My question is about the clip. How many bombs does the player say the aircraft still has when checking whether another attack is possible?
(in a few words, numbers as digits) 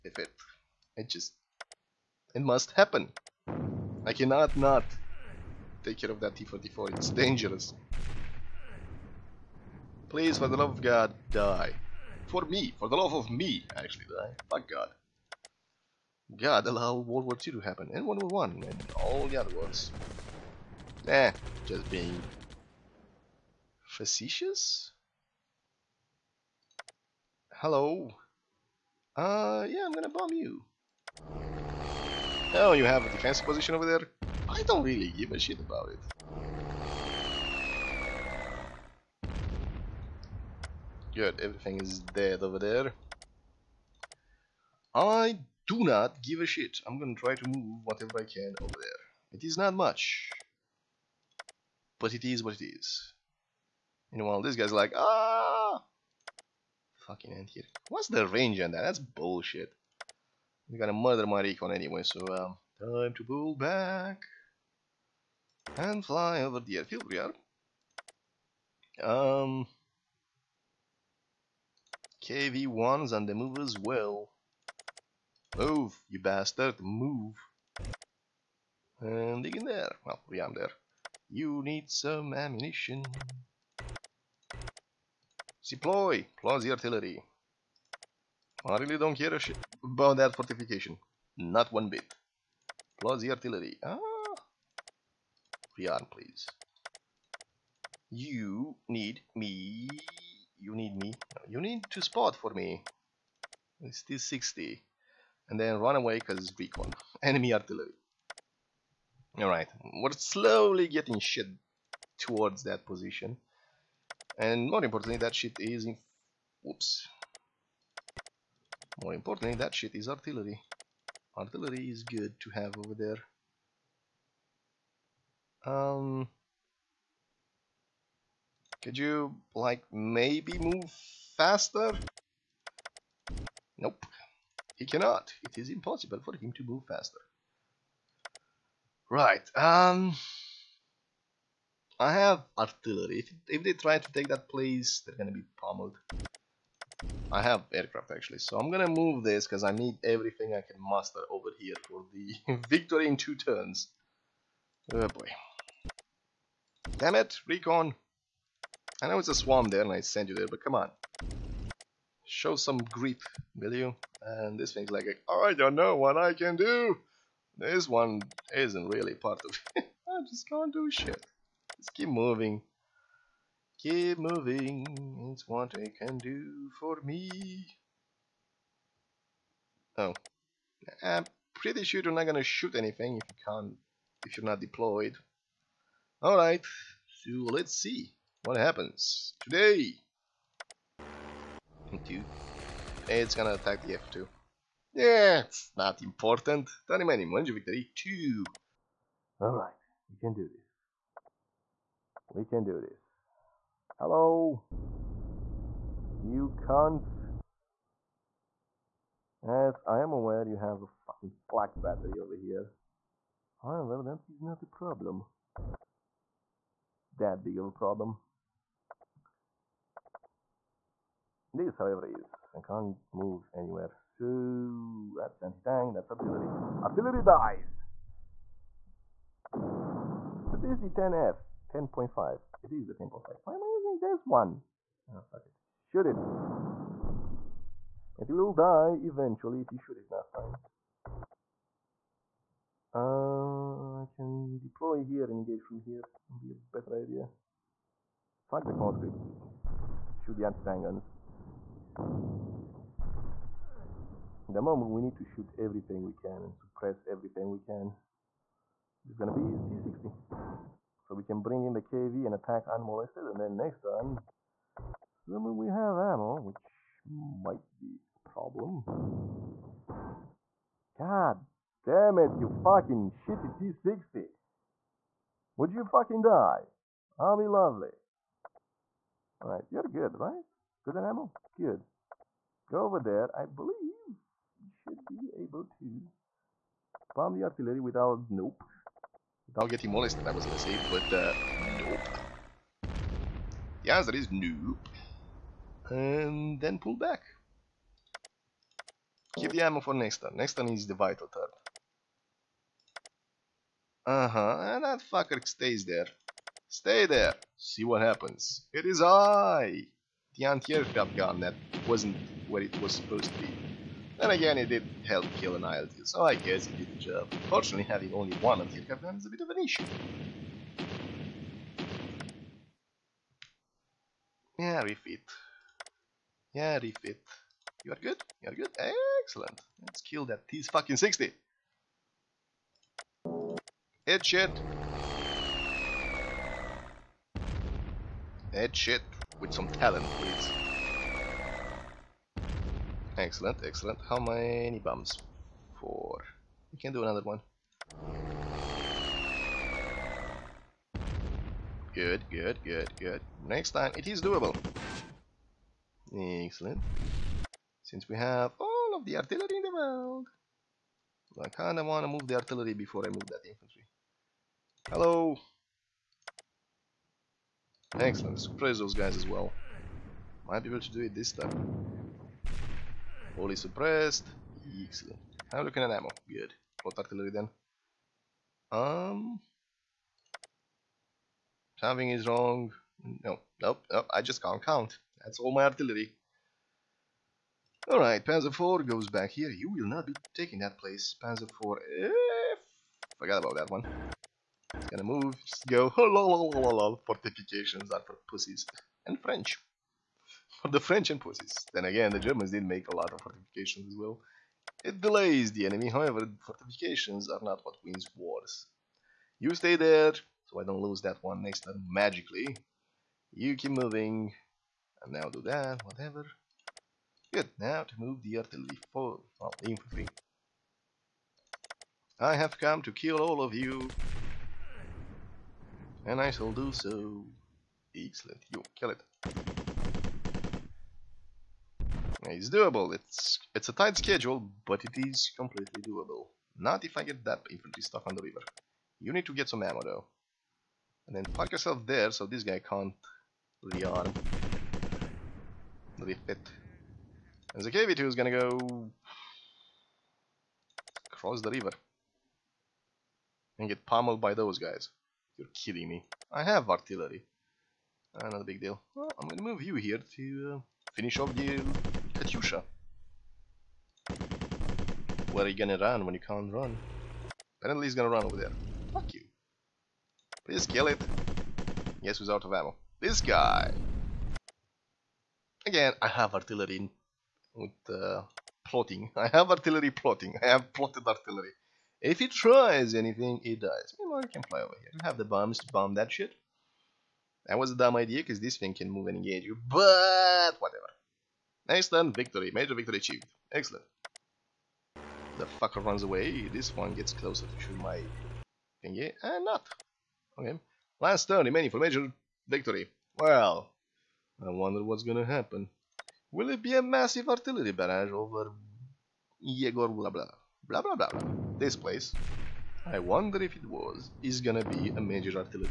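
4.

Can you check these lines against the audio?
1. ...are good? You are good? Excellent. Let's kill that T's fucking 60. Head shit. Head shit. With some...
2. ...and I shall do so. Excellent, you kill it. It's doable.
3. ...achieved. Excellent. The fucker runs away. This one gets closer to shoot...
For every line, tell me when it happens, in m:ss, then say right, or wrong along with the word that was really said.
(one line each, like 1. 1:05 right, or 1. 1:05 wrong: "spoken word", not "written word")
1. 5:27 right
2. 7:06 right
3. 8:12 right.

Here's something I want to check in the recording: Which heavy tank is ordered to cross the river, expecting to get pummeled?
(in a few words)
KV2.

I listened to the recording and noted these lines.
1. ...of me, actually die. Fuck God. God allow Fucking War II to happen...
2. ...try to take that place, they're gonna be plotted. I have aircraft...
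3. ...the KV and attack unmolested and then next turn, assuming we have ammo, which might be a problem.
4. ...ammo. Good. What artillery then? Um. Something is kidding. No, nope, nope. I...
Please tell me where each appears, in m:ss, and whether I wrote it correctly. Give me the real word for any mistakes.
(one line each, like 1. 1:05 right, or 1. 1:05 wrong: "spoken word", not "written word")
1. 0:13 wrong: "World", not "Fucking"
2. 2:23 wrong: "pummeled", not "plotted"
3. 4:21 right
4. 6:15 wrong: "wrong", not "kidding".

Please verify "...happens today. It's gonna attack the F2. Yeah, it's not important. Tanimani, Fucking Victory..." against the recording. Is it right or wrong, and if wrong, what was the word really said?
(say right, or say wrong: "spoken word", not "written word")
wrong: "Manju", not "Fucking".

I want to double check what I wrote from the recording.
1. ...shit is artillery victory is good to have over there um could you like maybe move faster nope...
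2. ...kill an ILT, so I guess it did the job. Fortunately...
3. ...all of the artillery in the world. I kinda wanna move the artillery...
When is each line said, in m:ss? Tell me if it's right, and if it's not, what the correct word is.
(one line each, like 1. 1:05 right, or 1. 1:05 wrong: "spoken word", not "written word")
1. 1:59 wrong: "artillery", not "victory"
2. 5:15 right
3. 5:58 right.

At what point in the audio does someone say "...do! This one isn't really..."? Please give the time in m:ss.
2:46.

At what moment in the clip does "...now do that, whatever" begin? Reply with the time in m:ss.
6:55.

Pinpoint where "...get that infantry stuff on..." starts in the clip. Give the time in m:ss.
7:17.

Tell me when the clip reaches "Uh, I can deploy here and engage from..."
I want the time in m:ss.
4:02.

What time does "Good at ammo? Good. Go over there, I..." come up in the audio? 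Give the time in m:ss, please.
4:40.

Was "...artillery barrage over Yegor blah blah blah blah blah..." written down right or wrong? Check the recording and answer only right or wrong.
right.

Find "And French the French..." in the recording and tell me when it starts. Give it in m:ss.
6:39.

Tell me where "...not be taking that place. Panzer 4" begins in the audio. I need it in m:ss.
6:29.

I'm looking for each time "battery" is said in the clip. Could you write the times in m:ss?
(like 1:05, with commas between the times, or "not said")
3:31.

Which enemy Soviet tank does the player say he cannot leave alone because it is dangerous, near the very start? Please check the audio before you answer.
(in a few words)
T-44.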